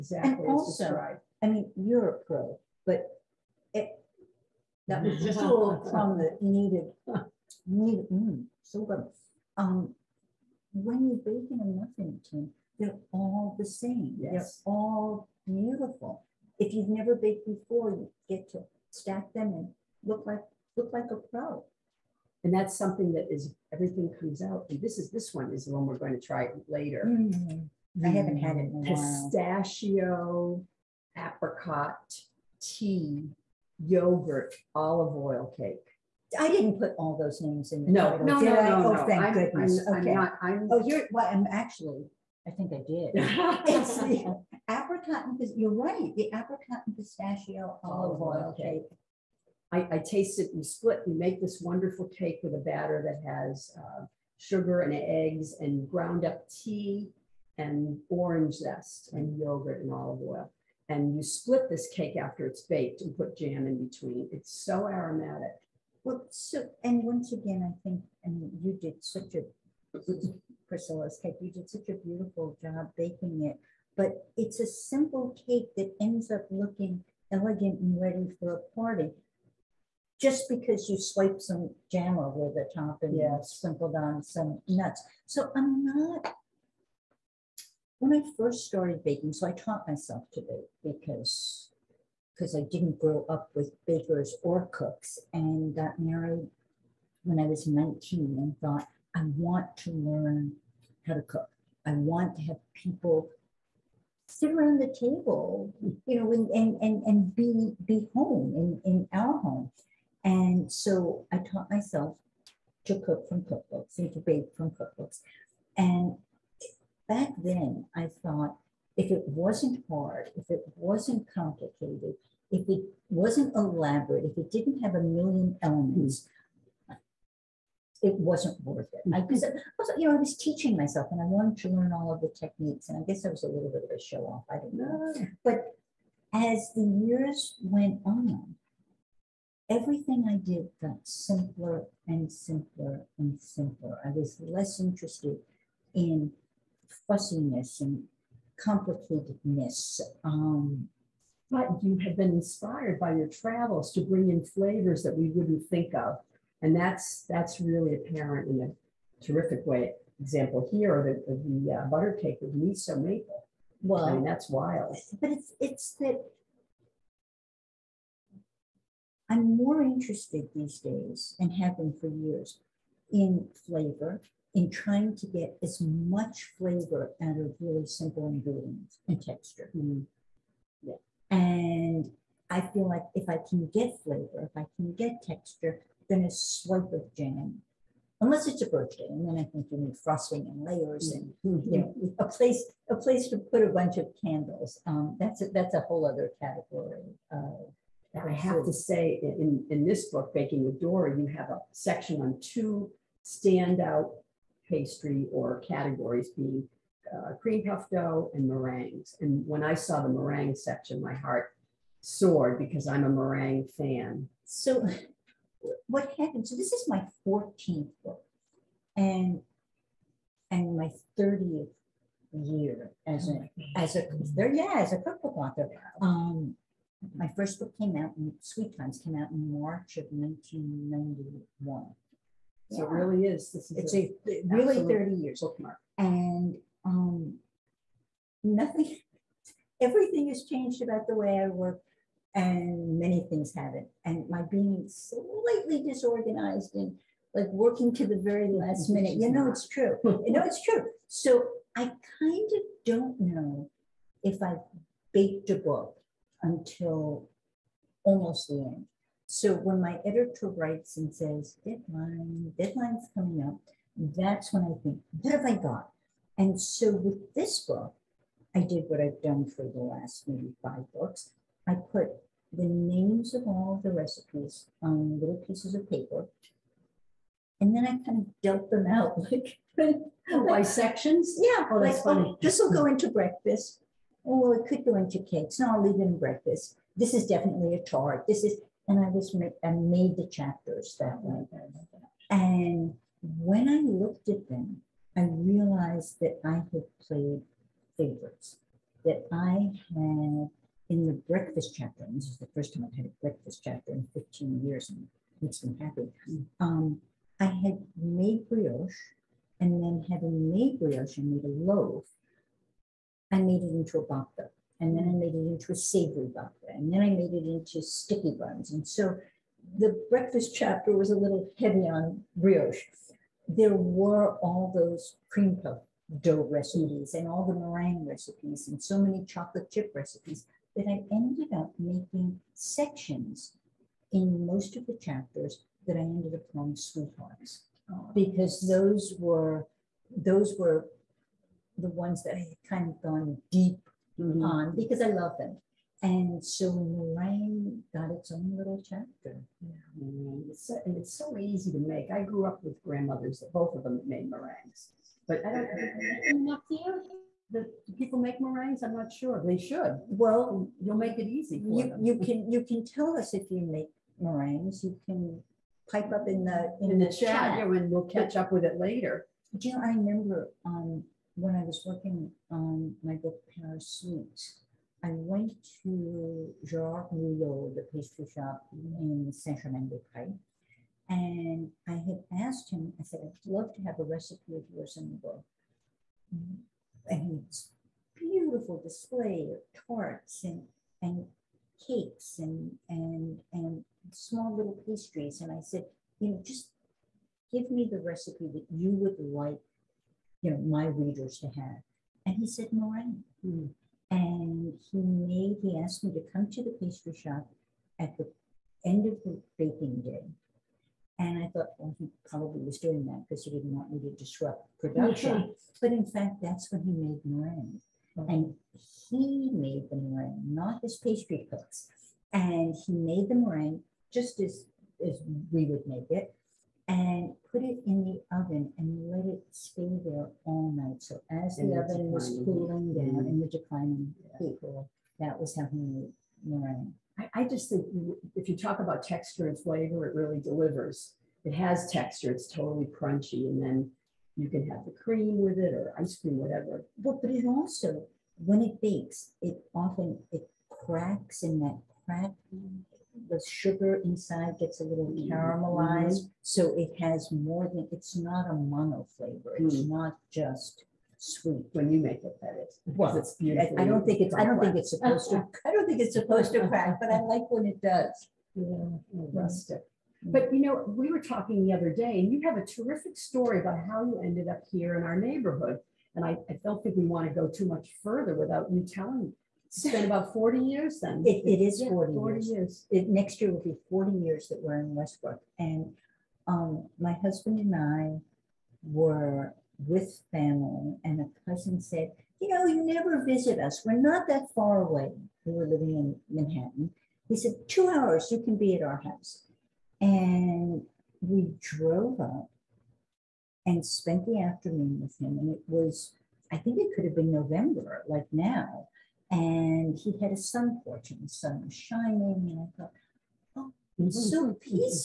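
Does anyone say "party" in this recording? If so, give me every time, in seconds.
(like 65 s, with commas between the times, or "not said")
78 s.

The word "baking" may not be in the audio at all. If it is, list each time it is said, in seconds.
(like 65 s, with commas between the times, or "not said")
11 s, 72 s, 89 s, 200 s, 409 s.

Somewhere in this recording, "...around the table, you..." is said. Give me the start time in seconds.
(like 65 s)
104 s.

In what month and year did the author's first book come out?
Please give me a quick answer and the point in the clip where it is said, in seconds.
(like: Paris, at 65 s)
March 1991, at 229 s.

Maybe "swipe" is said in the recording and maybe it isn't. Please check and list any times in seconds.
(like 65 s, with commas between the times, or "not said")
80 s, 186 s.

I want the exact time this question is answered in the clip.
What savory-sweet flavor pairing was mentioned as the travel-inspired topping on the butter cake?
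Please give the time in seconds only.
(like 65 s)
162 s.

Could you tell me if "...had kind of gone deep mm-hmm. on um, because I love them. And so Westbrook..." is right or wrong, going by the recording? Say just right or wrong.
wrong.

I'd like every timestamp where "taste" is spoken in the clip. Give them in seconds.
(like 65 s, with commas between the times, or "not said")
49 s.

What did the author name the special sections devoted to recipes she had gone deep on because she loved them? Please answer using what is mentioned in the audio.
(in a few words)
sweethearts.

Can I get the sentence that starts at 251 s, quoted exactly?
So I kind of don't know if I've baked a book until almost the end.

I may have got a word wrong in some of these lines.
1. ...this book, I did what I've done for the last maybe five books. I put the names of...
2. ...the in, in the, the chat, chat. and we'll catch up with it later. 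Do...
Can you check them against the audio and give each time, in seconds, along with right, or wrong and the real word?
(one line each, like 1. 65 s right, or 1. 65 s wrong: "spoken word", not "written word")
1. 267 s right
2. 366 s right.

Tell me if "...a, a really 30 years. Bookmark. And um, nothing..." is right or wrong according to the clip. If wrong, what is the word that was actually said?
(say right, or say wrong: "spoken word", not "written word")
right.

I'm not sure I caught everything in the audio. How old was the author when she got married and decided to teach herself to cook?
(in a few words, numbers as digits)
19.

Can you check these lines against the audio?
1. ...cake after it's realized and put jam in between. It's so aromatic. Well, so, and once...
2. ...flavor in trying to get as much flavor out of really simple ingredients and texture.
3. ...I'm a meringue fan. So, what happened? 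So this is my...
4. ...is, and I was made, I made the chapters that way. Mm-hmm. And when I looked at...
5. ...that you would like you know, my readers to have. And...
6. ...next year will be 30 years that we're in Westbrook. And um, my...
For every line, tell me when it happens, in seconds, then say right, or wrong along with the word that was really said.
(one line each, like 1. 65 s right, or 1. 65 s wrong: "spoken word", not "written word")
1. 61 s wrong: "baked", not "realized"
2. 173 s right
3. 212 s right
4. 288 s right
5. 398 s right
6. 483 s wrong: "40", not "30".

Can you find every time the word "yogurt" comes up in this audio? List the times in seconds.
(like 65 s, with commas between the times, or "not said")
33 s, 59 s.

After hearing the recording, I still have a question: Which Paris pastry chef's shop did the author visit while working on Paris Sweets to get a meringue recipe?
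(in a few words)
Gerard Mulot.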